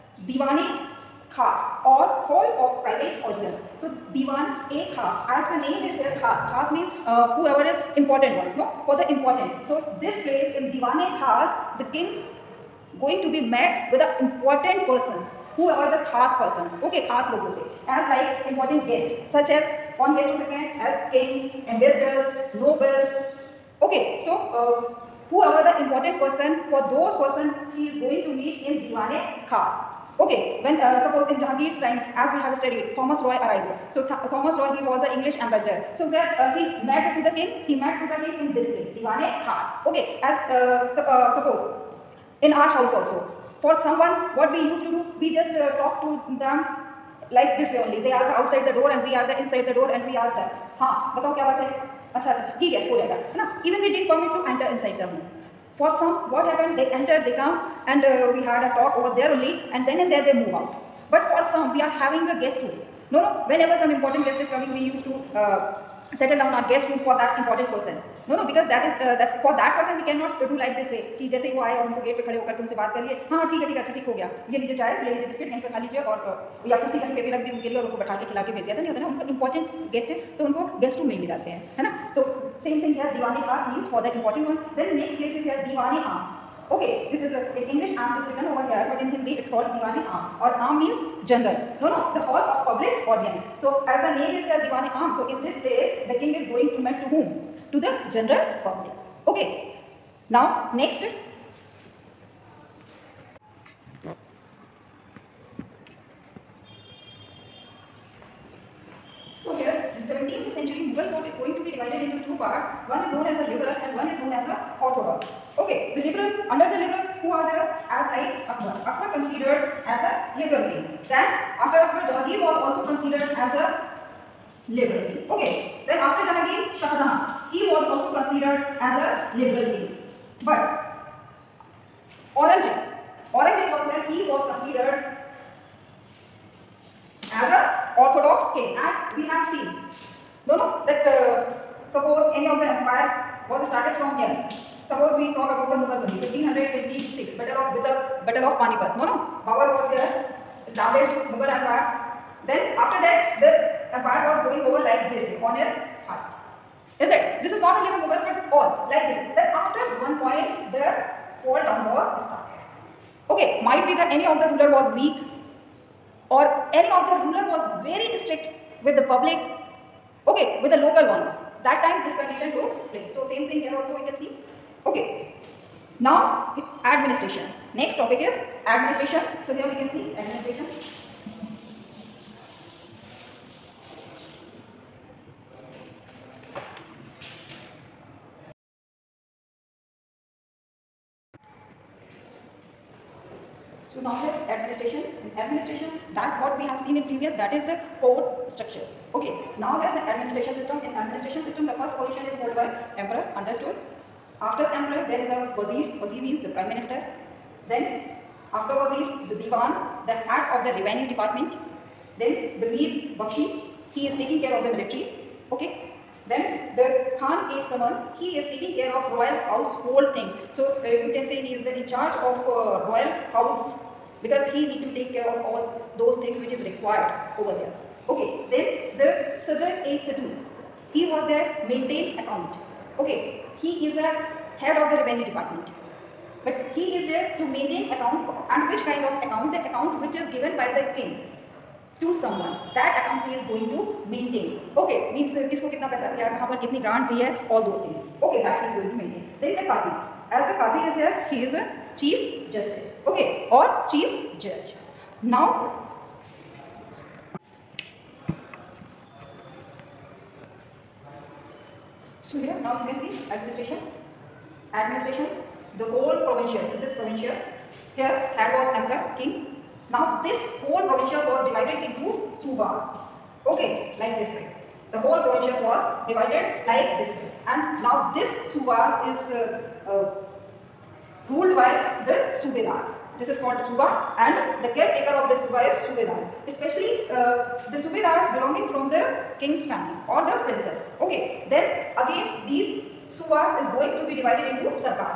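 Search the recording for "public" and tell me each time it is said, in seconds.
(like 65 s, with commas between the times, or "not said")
98 s, 169 s.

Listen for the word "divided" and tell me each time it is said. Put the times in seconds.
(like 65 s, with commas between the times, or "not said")
271 s, 276 s, 294 s.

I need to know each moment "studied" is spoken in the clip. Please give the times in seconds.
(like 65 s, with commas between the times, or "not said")
32 s.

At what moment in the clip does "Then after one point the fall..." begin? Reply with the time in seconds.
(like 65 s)
159 s.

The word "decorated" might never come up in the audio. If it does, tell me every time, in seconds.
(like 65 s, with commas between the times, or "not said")
not said.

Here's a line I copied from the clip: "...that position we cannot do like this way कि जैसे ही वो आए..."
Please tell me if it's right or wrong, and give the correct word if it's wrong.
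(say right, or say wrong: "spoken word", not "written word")
wrong: "person", not "position".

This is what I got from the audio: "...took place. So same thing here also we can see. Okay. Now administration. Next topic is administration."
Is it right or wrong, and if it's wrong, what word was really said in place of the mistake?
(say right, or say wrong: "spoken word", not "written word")
right.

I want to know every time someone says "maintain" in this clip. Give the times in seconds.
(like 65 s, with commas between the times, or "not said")
231 s, 237 s, 244 s.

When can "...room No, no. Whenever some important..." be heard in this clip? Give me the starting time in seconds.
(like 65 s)
62 s.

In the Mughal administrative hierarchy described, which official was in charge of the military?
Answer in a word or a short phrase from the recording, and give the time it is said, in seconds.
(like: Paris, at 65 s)
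Mir Bakshi, at 212 s.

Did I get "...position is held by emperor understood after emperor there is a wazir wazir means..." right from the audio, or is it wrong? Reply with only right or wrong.
right.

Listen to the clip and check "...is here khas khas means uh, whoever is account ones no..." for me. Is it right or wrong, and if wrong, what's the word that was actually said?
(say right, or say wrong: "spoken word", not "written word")
wrong: "important", not "account".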